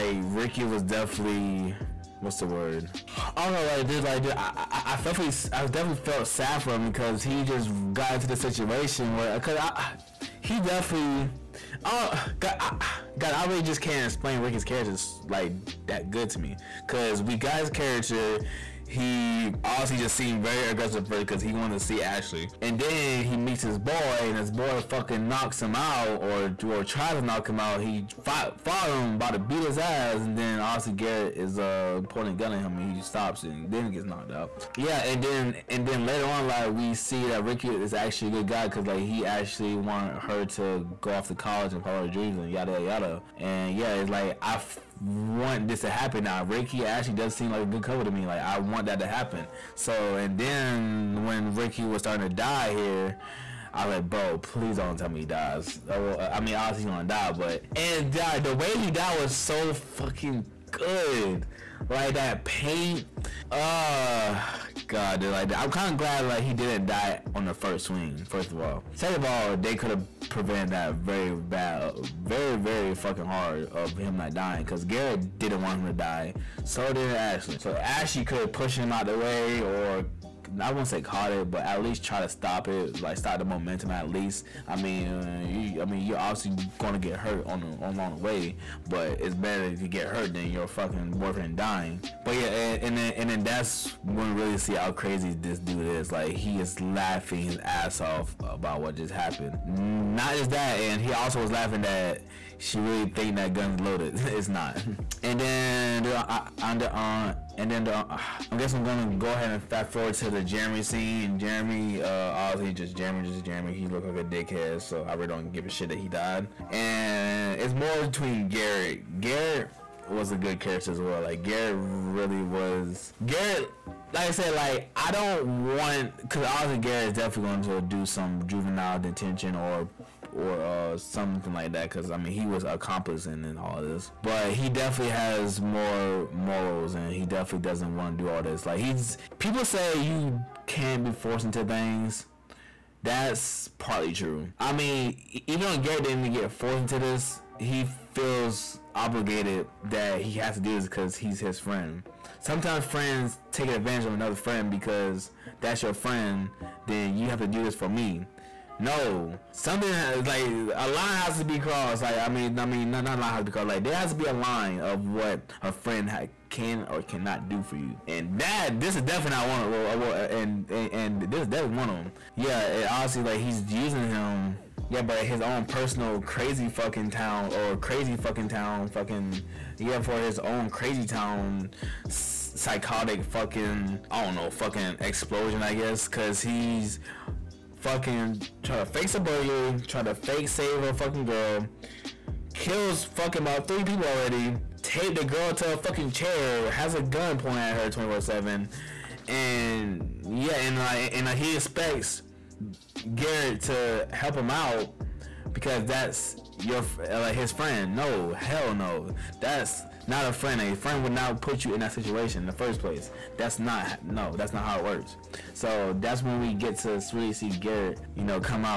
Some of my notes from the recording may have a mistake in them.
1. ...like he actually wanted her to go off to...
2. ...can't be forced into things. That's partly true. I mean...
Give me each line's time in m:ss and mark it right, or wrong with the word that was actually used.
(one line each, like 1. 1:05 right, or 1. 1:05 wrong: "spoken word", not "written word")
1. 0:38 right
2. 2:20 right.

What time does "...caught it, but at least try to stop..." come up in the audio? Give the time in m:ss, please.
1:20.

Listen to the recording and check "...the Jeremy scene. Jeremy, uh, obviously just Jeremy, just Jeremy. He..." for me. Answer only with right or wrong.
right.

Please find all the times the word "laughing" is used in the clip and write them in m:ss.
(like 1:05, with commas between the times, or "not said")
1:36, 1:41.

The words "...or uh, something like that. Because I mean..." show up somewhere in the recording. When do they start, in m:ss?
2:10.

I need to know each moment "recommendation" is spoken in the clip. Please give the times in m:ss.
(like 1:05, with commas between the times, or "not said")
not said.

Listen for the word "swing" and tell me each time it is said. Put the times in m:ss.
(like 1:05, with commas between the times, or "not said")
1:07.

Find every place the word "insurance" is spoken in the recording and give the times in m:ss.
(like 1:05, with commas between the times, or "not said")
not said.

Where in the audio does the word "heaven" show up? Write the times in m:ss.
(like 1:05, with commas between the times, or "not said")
not said.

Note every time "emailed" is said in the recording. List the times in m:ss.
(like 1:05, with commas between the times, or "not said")
not said.